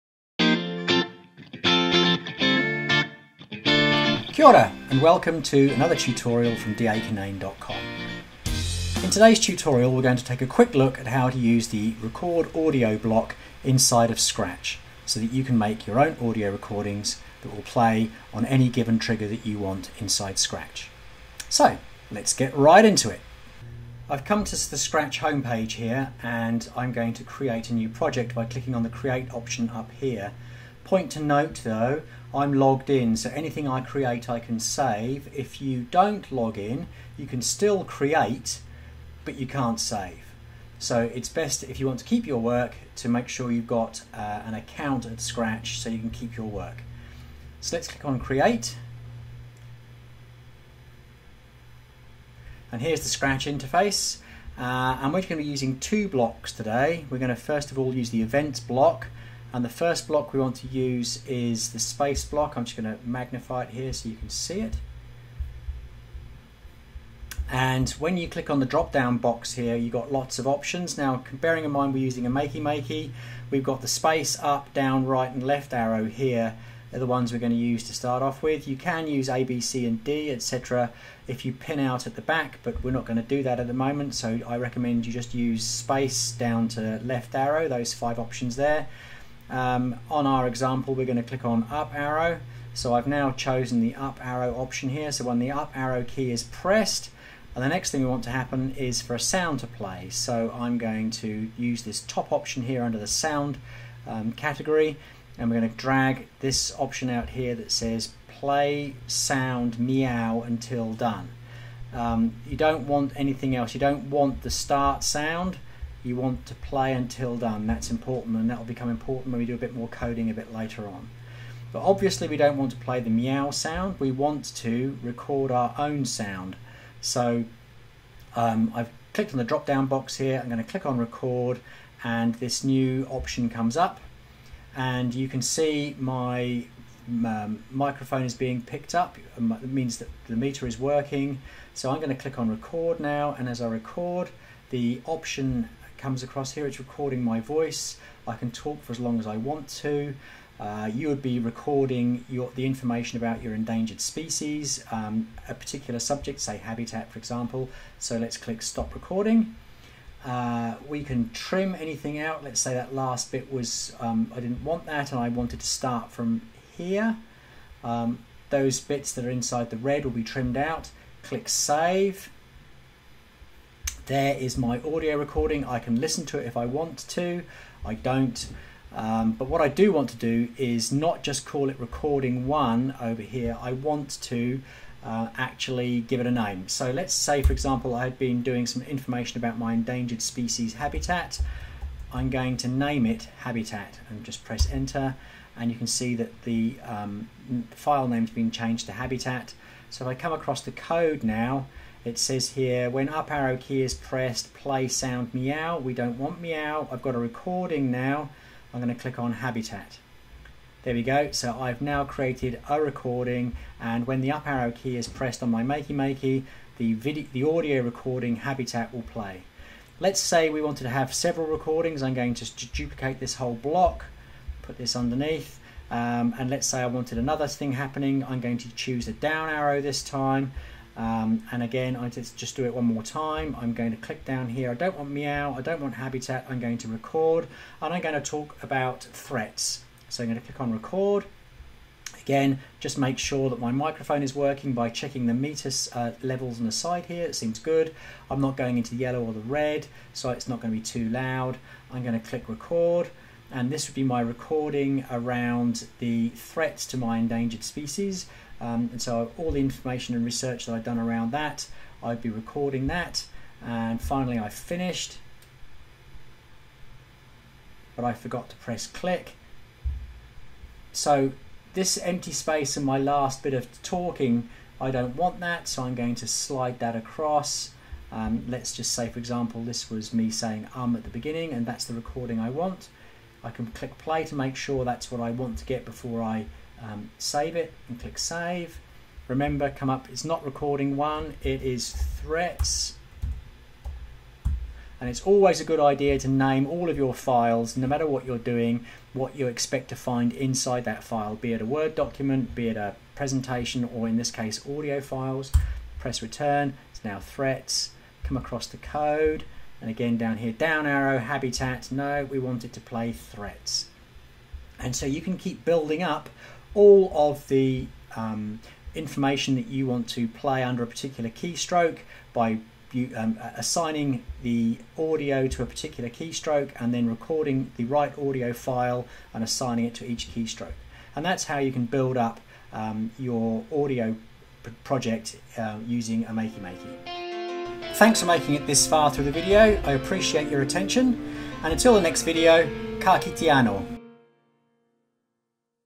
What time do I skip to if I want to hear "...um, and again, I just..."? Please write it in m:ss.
3:50.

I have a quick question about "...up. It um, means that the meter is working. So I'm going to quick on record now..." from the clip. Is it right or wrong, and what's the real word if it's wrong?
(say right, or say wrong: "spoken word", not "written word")
wrong: "click", not "quick".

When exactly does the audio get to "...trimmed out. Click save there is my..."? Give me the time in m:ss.
2:50.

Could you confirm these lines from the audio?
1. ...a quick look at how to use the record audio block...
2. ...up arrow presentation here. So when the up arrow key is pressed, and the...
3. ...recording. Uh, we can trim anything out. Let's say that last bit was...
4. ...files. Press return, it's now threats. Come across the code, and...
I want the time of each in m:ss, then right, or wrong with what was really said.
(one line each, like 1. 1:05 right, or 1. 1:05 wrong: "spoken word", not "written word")
1. 0:10 right
2. 1:33 wrong: "option", not "presentation"
3. 2:38 right
4. 5:05 right.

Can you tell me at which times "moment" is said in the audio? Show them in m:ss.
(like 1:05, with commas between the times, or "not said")
1:23.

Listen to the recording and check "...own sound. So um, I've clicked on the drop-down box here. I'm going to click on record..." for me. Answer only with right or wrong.
right.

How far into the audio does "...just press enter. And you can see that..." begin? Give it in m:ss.
3:14.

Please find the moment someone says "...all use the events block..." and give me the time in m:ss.
0:57.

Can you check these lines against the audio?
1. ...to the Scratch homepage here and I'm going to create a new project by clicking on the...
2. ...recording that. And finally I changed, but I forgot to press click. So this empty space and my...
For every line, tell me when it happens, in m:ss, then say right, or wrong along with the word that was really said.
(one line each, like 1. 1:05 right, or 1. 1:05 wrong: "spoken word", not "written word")
1. 0:24 right
2. 4:22 wrong: "finished", not "changed".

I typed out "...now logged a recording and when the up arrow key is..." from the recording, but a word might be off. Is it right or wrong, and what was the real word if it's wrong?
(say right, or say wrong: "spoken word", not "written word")
wrong: "created", not "logged".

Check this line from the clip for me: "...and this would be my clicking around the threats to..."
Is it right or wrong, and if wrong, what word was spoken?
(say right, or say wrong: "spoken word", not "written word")
wrong: "recording", not "clicking".